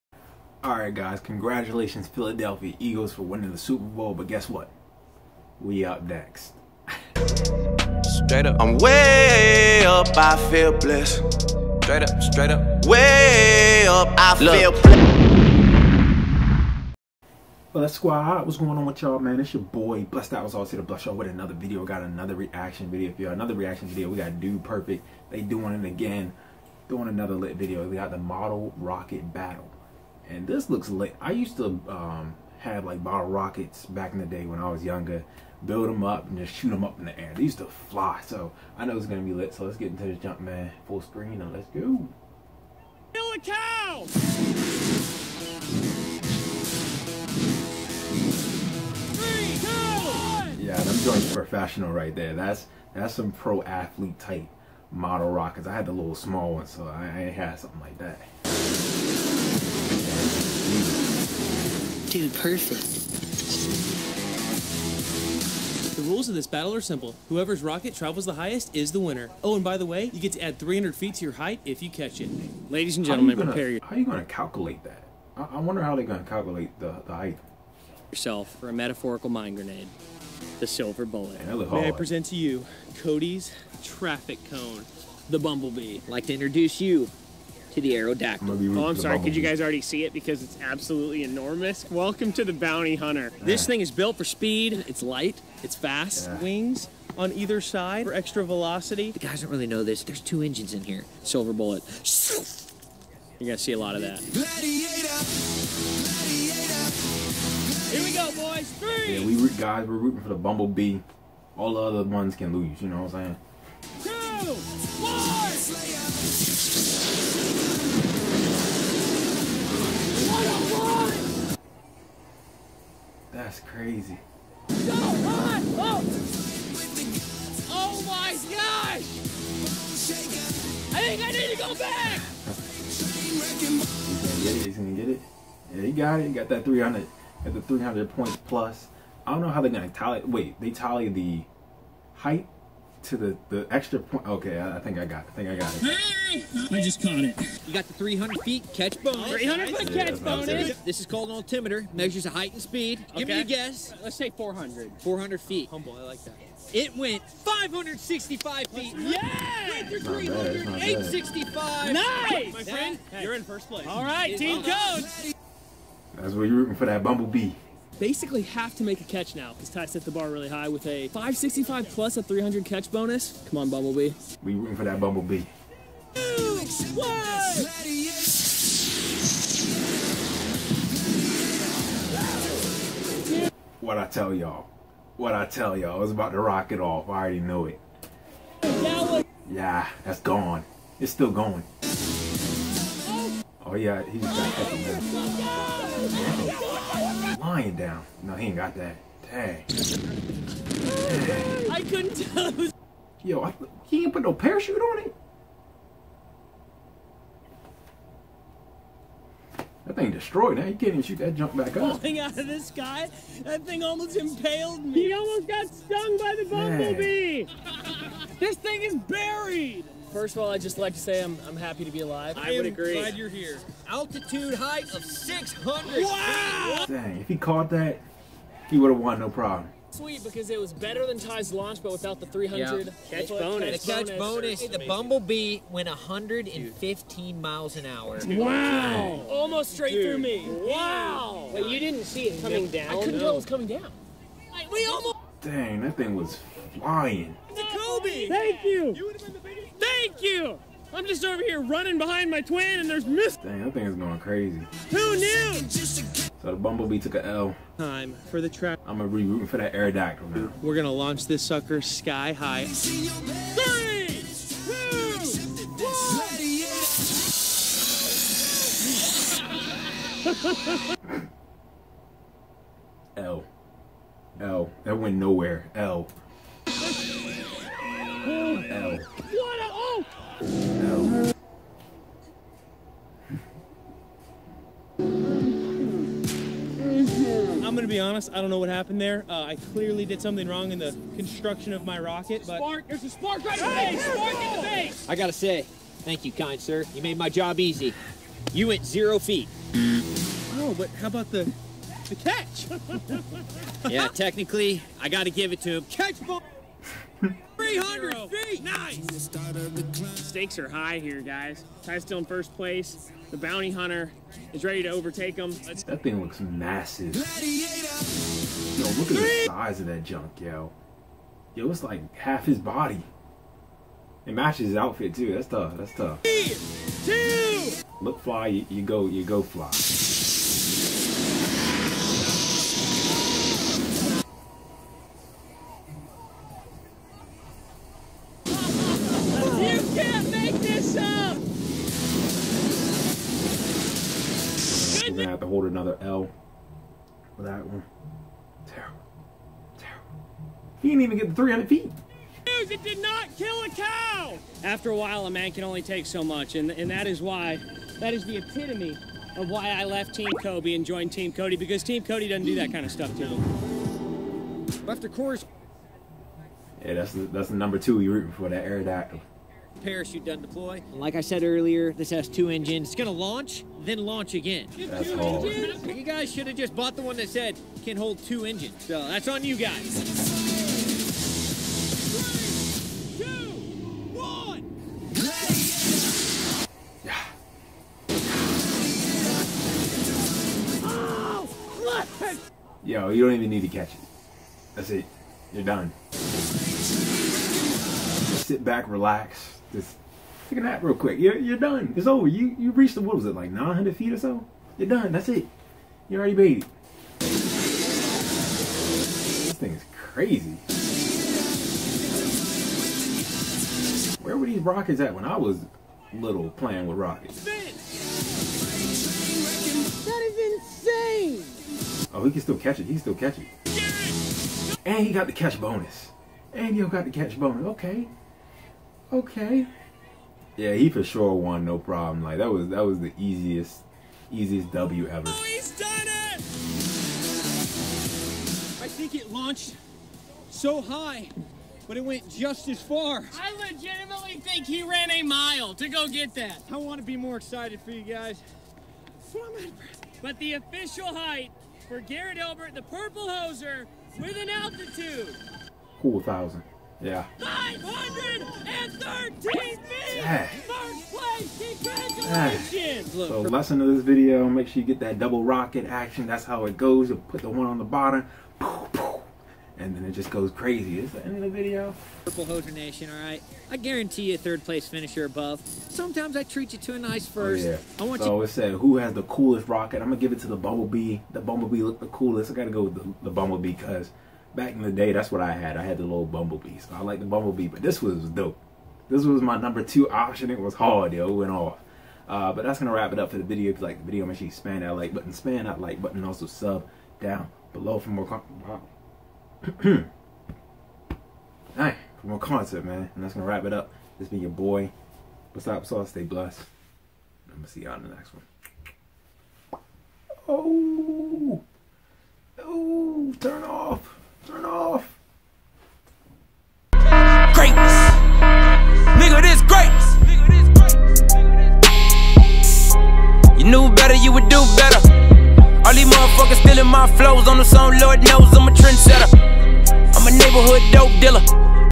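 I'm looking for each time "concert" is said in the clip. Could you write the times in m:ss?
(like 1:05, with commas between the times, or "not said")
8:22.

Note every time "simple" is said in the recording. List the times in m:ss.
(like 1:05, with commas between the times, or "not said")
1:06.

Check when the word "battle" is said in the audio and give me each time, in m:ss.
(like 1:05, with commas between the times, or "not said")
0:29, 1:06.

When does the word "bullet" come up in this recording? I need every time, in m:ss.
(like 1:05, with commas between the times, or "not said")
1:21, 1:41.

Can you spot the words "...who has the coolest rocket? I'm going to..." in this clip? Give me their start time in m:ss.
7:58.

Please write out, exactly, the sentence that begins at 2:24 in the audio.
Okay, I, I, think I got it.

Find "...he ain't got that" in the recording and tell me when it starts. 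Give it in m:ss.
3:18.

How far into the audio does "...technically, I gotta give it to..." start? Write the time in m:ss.
5:04.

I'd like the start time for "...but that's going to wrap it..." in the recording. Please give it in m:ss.
8:12.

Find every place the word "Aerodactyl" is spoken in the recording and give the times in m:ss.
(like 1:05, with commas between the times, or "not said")
1:27, 4:19, 6:08.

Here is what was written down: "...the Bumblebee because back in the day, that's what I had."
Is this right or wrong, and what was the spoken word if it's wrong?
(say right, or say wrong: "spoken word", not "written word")
right.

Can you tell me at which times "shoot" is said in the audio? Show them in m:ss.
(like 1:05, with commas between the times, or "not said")
0:36, 3:31.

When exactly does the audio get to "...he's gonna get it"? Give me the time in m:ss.
2:14.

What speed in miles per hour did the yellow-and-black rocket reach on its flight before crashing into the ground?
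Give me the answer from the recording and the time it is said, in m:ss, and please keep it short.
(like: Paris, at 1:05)
115, at 3:55.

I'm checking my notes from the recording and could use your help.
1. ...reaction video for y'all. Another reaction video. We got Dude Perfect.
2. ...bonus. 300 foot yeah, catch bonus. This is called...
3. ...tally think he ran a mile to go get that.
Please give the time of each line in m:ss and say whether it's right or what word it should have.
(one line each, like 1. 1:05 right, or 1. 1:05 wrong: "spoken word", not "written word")
1. 0:22 right
2. 2:29 right
3. 7:23 wrong: "legitimately", not "tally".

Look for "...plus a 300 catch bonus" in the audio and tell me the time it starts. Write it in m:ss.
2:51.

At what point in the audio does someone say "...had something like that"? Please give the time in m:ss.
0:57.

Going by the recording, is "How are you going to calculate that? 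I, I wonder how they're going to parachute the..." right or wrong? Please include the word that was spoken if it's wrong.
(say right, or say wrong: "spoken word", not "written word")
wrong: "calculate", not "parachute".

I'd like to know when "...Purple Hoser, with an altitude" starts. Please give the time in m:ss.
7:32.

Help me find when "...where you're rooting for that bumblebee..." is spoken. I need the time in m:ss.
2:46.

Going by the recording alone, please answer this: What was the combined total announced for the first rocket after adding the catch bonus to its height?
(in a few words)
865.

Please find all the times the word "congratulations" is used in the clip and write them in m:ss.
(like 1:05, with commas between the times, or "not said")
0:01, 7:41.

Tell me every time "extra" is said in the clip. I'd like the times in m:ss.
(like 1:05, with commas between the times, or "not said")
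1:38, 2:23.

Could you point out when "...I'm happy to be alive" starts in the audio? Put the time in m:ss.
3:41.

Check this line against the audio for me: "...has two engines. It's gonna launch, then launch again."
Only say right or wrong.
right.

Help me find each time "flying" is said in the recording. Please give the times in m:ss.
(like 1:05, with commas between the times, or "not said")
4:06.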